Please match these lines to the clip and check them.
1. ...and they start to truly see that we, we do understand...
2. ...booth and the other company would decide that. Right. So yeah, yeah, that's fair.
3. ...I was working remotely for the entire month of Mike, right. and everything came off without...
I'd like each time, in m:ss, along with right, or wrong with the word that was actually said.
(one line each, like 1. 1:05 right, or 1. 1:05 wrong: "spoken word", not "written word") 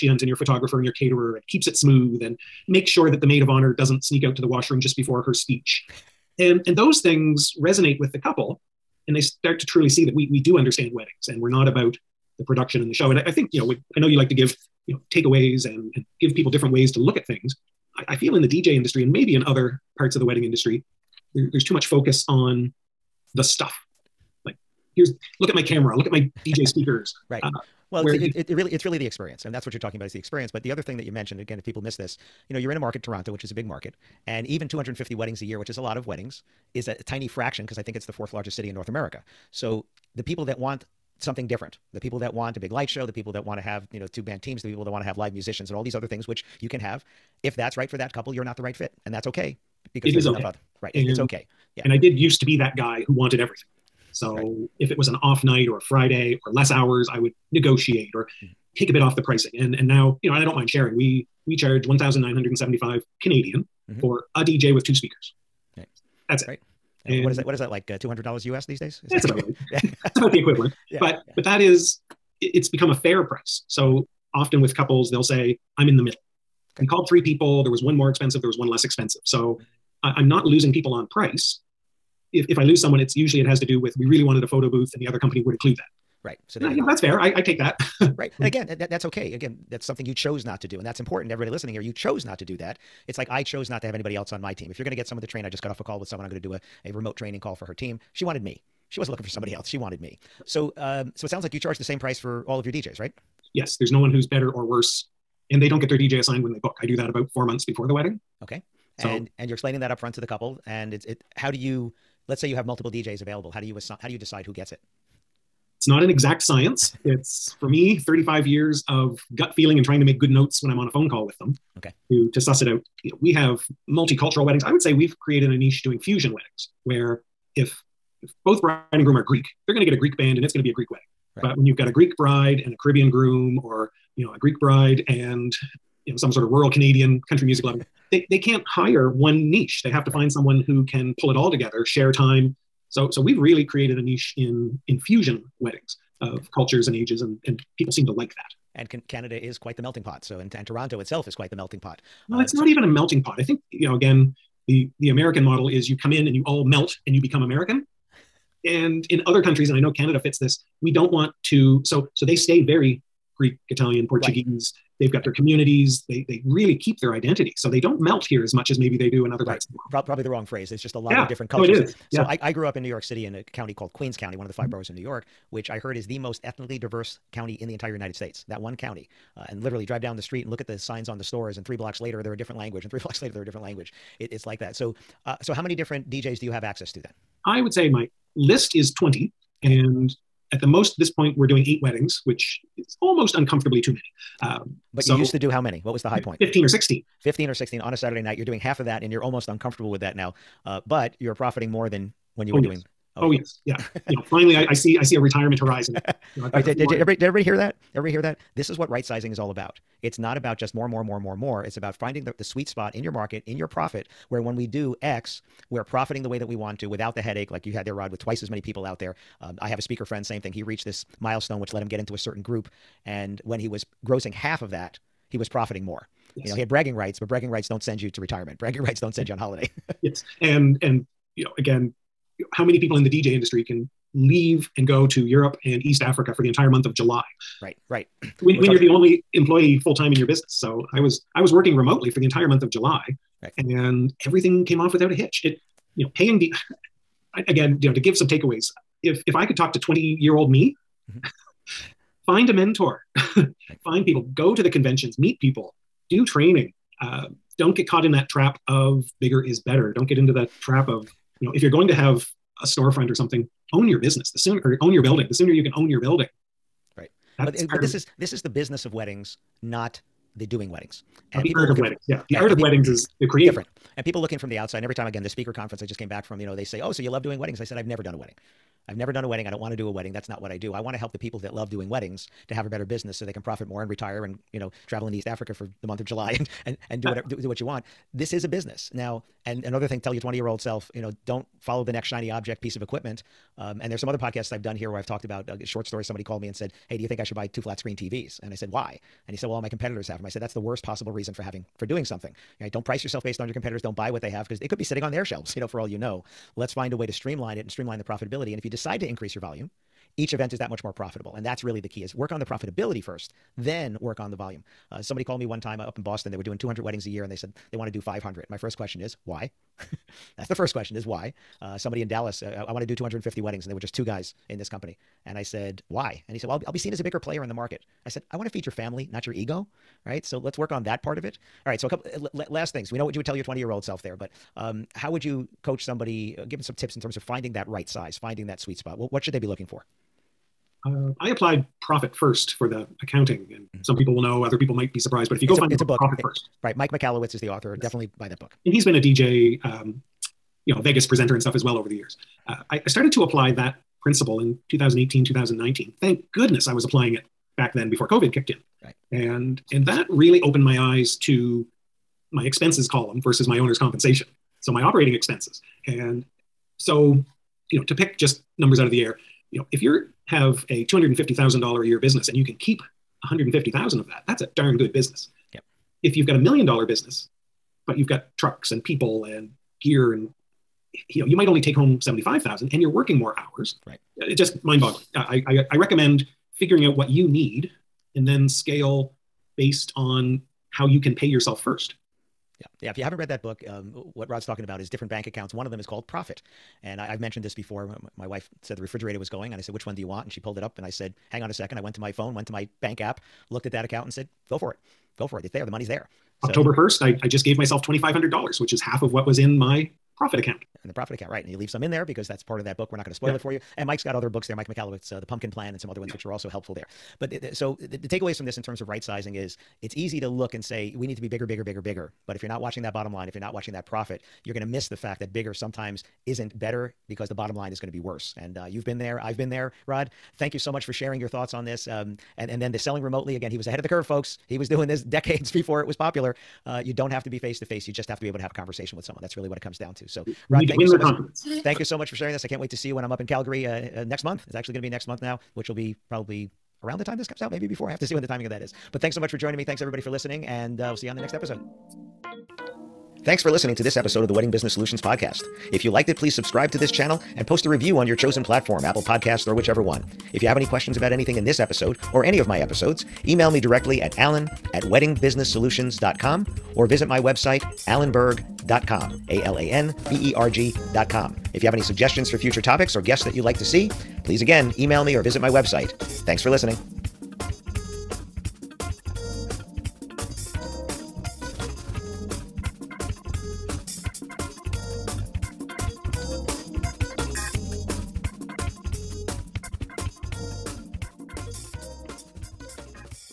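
1. 0:09 right
2. 1:24 wrong: "include", not "decide"
3. 4:01 wrong: "July", not "Mike".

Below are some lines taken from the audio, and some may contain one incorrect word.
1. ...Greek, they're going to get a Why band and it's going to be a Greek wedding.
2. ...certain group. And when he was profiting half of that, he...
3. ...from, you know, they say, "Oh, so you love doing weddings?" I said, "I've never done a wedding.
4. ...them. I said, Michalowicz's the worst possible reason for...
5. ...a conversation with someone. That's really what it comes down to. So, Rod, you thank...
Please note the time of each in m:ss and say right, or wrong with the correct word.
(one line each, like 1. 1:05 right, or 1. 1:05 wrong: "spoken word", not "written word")
1. 2:09 wrong: "Greek", not "Why"
2. 3:42 wrong: "grossing", not "profiting"
3. 4:36 right
4. 5:00 wrong: "That", not "Michalowicz"
5. 7:18 right.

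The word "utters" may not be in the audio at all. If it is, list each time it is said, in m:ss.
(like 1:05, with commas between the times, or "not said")
not said.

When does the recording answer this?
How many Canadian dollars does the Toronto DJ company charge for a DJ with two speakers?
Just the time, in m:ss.
1:01.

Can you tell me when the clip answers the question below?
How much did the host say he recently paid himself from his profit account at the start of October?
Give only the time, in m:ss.
6:47.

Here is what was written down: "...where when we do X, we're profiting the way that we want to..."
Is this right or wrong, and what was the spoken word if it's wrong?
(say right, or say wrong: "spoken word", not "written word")
right.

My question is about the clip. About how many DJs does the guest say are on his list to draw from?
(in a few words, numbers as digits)
20.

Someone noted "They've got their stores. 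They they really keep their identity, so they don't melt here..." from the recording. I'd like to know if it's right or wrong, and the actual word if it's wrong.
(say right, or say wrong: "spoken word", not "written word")
wrong: "communities", not "stores".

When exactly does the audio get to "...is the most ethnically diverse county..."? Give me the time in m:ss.
2:55.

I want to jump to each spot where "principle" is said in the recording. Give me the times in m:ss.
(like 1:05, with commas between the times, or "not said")
5:54.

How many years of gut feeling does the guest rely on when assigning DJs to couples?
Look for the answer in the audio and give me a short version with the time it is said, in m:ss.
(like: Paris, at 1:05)
35, at 1:57.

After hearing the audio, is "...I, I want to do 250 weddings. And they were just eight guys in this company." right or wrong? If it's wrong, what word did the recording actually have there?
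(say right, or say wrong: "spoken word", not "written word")
wrong: "two", not "eight".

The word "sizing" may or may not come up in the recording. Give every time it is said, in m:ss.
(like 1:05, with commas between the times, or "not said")
3:29, 6:59.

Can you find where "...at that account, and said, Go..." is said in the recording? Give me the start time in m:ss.
6:43.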